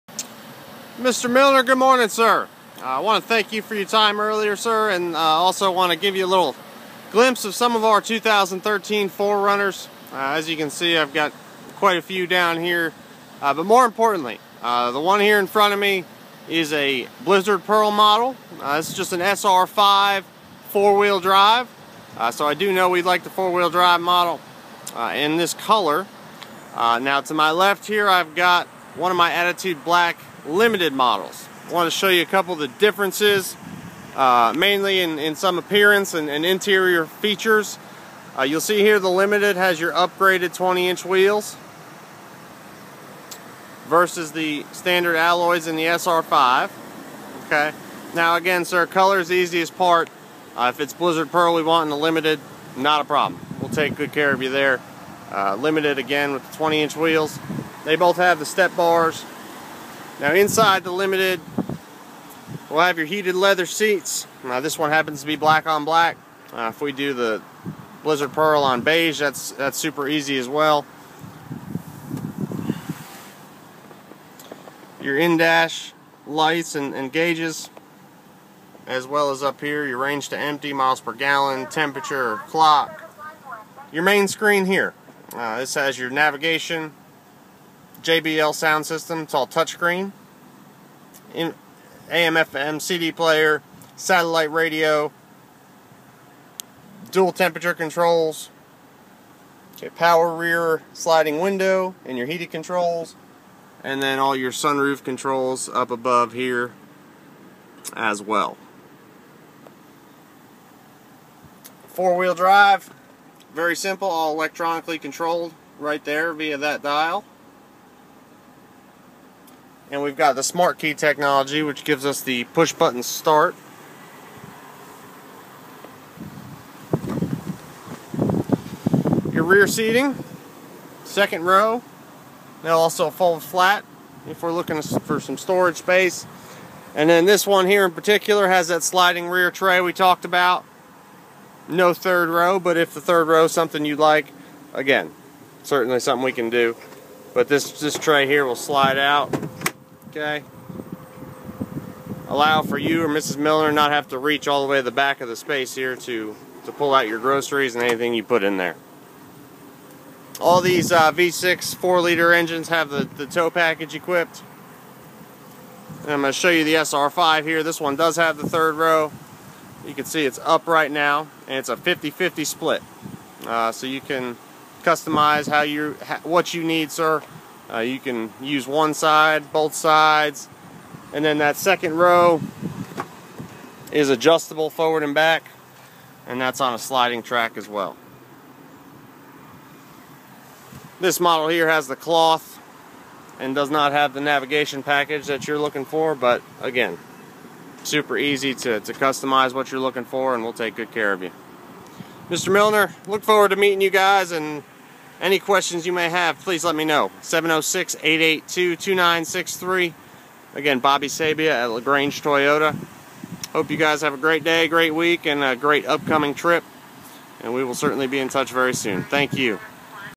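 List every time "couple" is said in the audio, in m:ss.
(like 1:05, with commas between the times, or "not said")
0:32.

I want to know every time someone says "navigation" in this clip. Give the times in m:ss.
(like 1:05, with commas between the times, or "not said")
1:26, 3:14.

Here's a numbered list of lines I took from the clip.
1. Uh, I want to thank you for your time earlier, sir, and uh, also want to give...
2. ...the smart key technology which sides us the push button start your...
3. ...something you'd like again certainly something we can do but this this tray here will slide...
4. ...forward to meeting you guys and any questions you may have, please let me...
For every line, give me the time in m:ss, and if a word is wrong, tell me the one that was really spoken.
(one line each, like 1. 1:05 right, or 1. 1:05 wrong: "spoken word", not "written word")
1. 0:02 right
2. 2:00 wrong: "gives", not "sides"
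3. 2:23 right
4. 3:23 right.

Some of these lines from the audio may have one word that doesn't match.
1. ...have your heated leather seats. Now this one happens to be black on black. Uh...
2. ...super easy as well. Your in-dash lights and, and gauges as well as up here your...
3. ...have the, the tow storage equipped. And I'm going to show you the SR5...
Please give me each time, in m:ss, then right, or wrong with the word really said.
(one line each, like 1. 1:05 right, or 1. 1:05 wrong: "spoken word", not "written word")
1. 1:02 right
2. 1:09 right
3. 2:42 wrong: "package", not "storage".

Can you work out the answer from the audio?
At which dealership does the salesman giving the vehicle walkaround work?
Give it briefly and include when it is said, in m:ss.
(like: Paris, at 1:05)
LaGrange Toyota, at 3:31.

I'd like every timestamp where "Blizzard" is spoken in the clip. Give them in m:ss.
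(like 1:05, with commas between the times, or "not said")
0:17, 0:50, 1:08.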